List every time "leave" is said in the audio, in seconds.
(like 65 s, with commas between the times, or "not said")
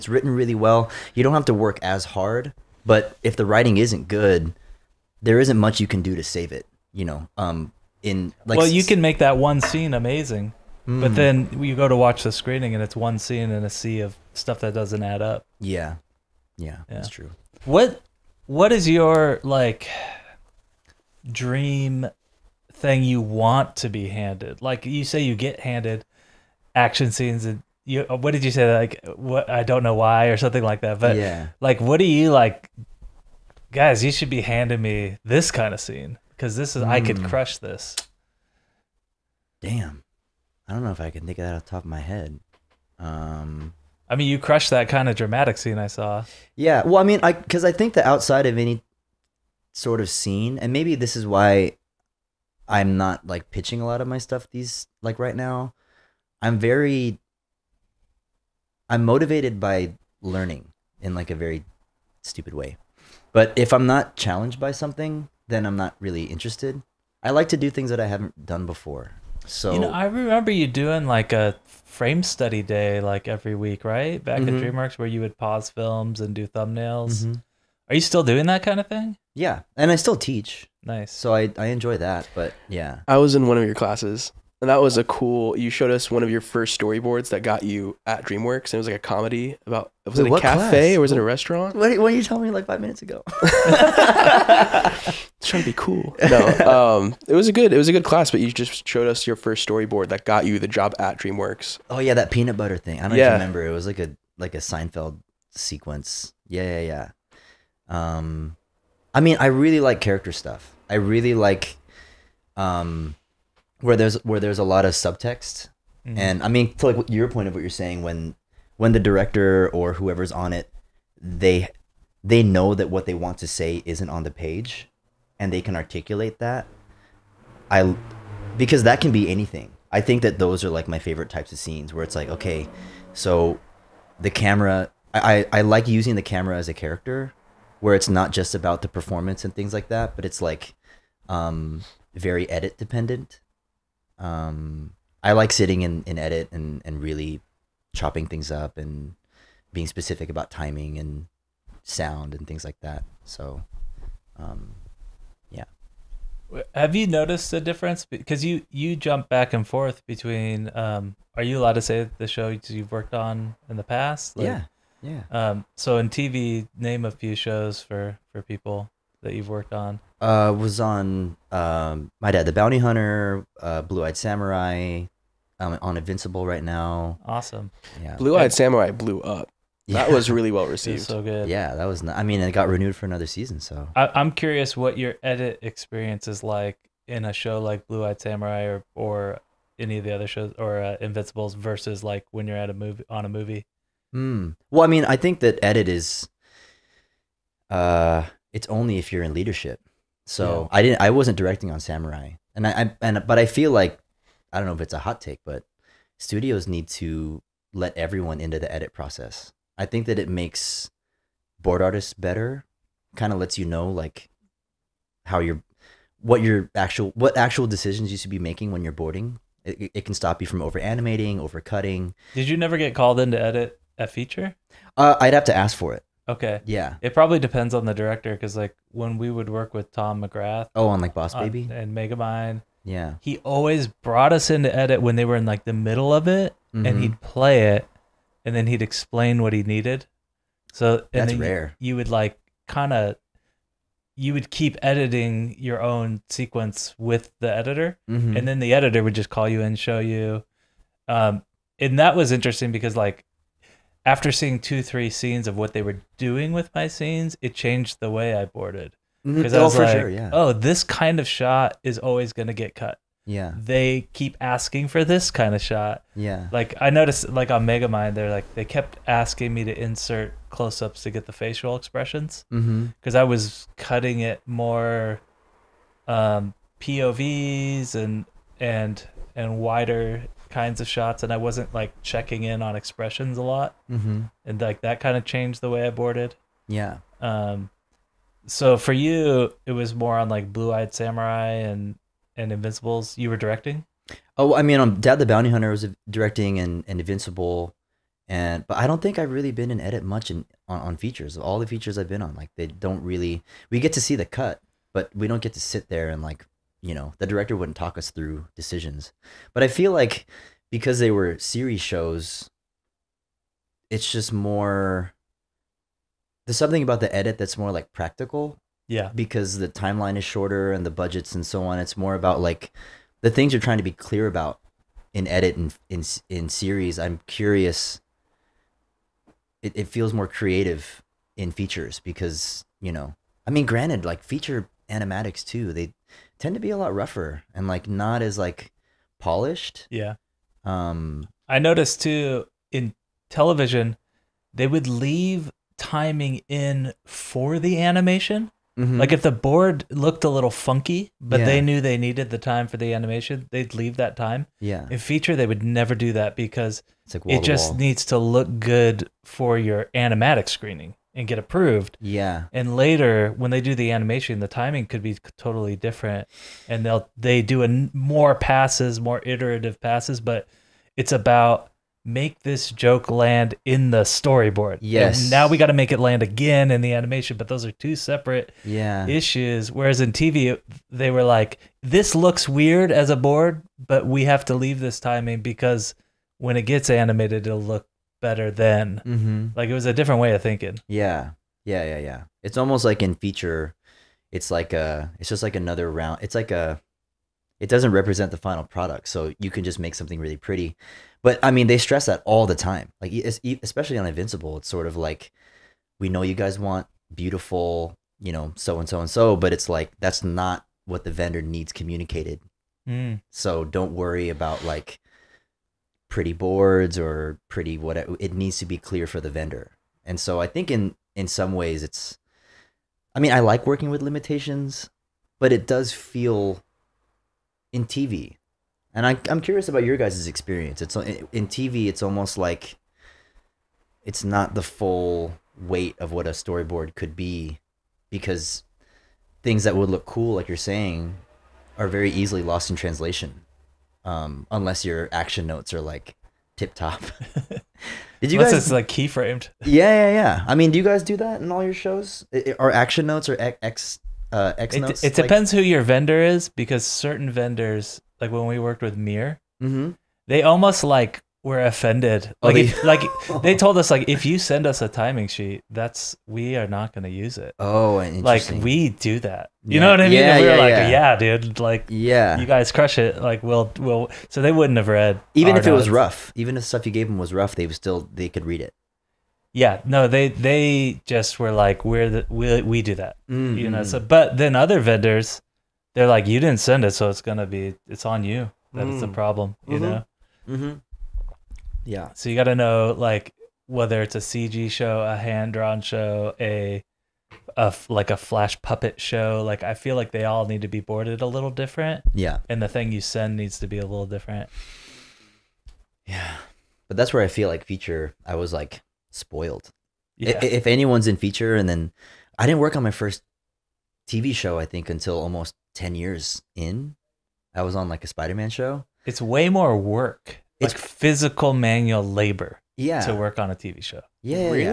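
344 s, 353 s, 384 s.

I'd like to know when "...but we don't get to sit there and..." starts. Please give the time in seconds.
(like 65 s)
304 s.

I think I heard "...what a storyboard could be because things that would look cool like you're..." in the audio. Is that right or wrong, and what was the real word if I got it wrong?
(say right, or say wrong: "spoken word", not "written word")
right.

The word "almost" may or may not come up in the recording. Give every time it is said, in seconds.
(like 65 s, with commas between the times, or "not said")
392 s, 432 s, 460 s, 515 s.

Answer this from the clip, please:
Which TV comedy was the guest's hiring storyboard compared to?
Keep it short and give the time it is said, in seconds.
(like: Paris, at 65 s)
Seinfeld, at 104 s.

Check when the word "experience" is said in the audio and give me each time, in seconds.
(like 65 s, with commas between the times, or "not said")
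185 s, 430 s.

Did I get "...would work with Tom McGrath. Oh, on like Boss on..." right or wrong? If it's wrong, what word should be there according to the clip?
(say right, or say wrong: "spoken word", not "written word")
right.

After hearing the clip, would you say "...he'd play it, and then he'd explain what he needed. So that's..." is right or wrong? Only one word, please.
right.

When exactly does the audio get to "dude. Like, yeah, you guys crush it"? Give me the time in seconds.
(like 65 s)
471 s.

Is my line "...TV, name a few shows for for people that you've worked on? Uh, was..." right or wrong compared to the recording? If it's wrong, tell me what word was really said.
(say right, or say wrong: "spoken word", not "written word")
right.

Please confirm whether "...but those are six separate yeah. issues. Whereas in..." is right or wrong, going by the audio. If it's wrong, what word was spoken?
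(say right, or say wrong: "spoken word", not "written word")
wrong: "two", not "six".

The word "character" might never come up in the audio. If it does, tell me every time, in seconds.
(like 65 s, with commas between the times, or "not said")
110 s, 136 s.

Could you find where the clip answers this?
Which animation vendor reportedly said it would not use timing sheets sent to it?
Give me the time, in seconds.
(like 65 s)
458 s.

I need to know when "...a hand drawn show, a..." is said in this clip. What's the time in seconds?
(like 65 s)
495 s.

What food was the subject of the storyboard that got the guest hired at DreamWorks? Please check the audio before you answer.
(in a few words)
peanut butter.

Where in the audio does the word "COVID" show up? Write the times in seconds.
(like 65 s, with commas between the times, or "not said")
not said.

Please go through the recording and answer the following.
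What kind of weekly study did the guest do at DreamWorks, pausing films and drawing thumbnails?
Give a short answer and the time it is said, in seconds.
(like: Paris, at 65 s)
frame study day, at 71 s.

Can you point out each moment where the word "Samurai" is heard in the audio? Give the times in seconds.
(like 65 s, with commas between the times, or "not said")
174 s, 178 s, 188 s, 201 s, 290 s.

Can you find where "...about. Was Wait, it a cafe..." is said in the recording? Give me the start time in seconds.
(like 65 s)
89 s.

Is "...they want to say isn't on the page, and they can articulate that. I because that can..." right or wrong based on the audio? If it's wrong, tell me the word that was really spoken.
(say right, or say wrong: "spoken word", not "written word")
right.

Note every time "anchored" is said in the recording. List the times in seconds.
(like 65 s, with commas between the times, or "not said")
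not said.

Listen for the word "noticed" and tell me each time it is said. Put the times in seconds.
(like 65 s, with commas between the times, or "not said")
157 s, 266 s, 341 s.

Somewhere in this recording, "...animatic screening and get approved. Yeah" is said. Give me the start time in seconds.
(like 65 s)
359 s.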